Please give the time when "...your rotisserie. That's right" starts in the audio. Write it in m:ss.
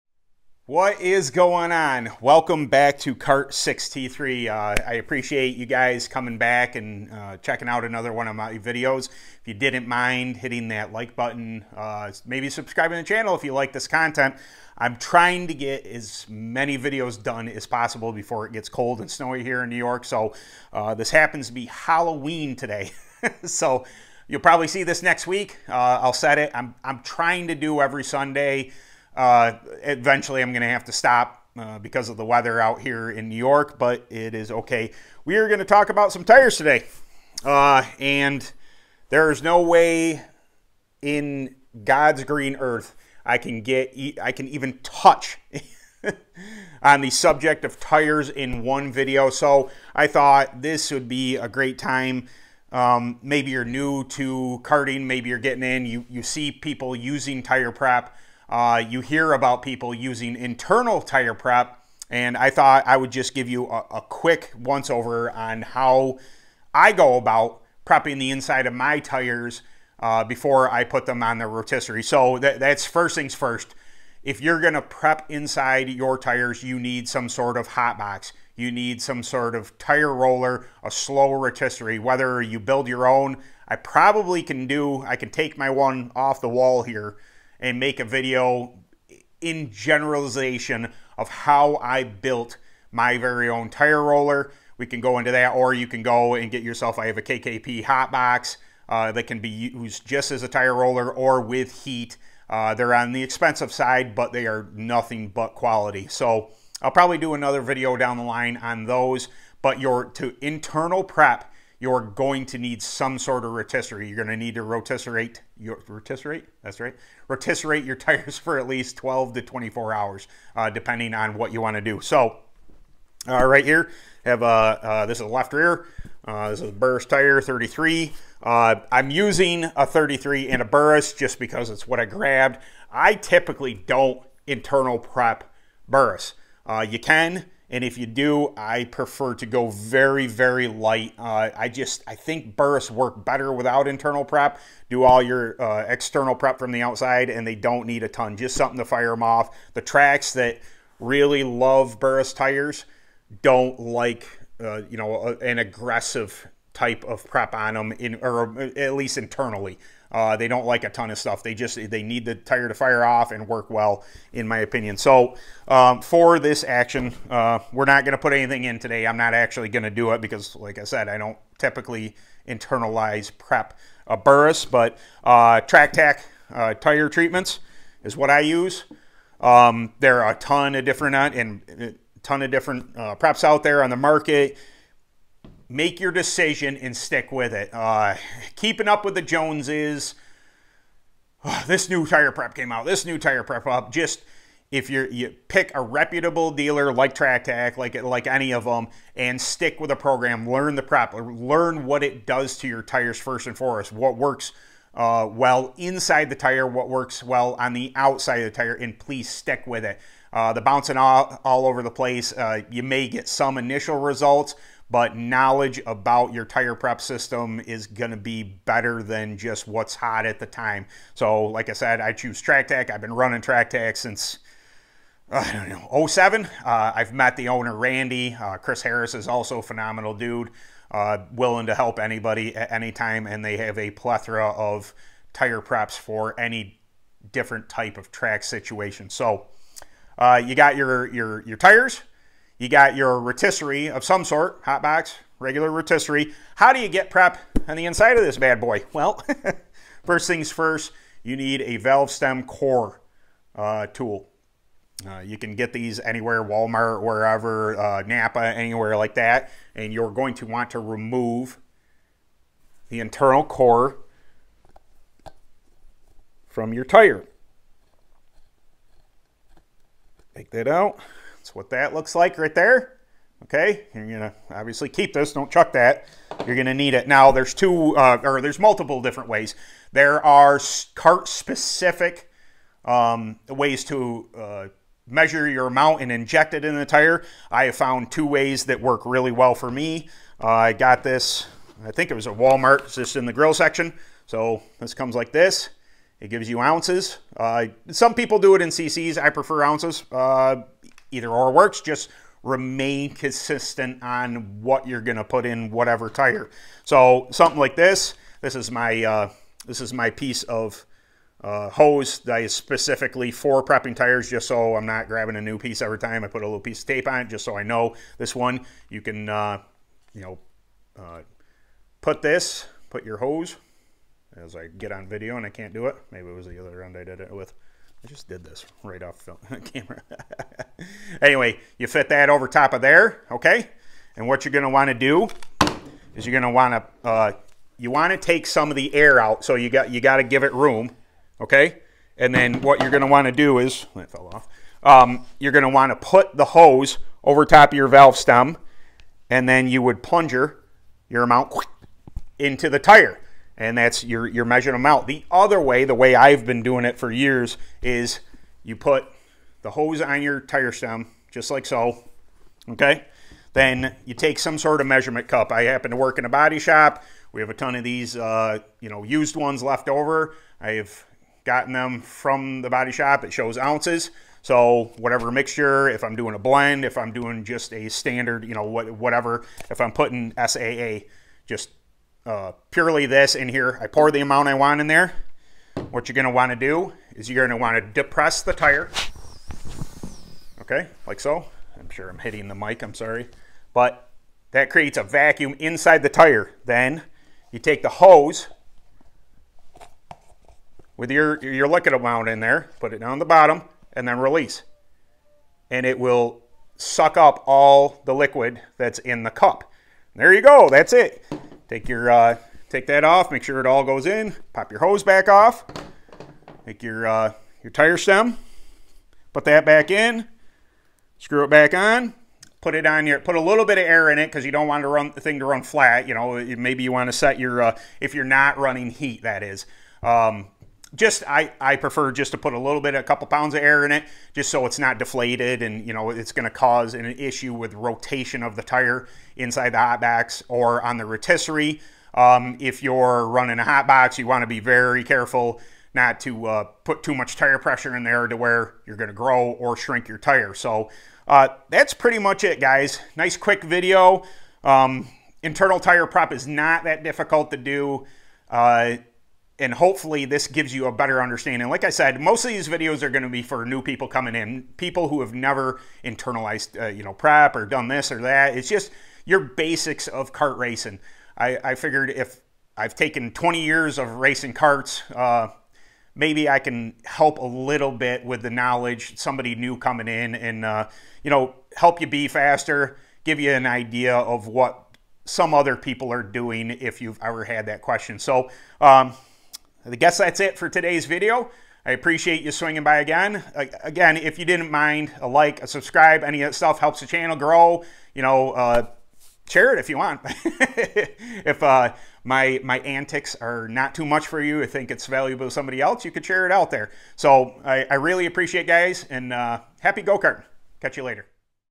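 1:55.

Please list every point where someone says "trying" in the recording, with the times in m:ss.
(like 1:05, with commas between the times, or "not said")
0:14, 0:27.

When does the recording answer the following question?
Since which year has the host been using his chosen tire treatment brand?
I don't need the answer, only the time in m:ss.
3:46.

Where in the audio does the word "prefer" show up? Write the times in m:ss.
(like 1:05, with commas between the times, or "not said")
2:18, 4:59, 7:11.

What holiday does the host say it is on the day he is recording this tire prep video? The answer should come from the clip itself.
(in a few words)
Halloween.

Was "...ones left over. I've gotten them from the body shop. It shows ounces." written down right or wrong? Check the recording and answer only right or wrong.
right.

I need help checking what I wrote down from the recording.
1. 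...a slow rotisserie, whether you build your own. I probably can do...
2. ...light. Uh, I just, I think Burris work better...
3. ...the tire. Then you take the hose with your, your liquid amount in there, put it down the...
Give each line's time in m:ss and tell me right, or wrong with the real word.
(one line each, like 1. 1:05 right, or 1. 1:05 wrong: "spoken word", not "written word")
1. 1:20 right
2. 2:20 right
3. 6:36 right.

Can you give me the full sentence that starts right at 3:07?
Uh, keeping up with the Joneses.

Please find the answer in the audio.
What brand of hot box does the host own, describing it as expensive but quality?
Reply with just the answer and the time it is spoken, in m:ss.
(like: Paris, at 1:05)
KKP, at 1:37.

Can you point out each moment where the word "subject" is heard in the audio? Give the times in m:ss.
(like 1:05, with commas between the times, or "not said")
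0:47.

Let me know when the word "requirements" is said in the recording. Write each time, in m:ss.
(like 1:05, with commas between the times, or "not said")
not said.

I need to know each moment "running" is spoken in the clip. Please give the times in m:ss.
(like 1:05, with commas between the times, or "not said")
3:43, 7:08, 7:23.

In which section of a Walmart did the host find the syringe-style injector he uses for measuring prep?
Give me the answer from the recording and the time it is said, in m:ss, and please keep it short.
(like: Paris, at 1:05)
the grill section, at 4:53.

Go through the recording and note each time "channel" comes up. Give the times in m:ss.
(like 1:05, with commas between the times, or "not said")
0:13, 8:17.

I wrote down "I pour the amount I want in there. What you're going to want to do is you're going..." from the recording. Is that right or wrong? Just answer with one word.
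right.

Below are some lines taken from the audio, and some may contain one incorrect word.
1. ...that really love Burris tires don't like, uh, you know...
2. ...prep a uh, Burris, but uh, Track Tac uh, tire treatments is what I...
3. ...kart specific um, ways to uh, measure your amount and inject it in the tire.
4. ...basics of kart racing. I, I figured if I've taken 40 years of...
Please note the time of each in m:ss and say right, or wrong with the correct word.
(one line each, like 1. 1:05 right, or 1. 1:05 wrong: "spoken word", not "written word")
1. 2:30 right
2. 2:53 right
3. 4:40 right
4. 7:49 wrong: "20", not "40".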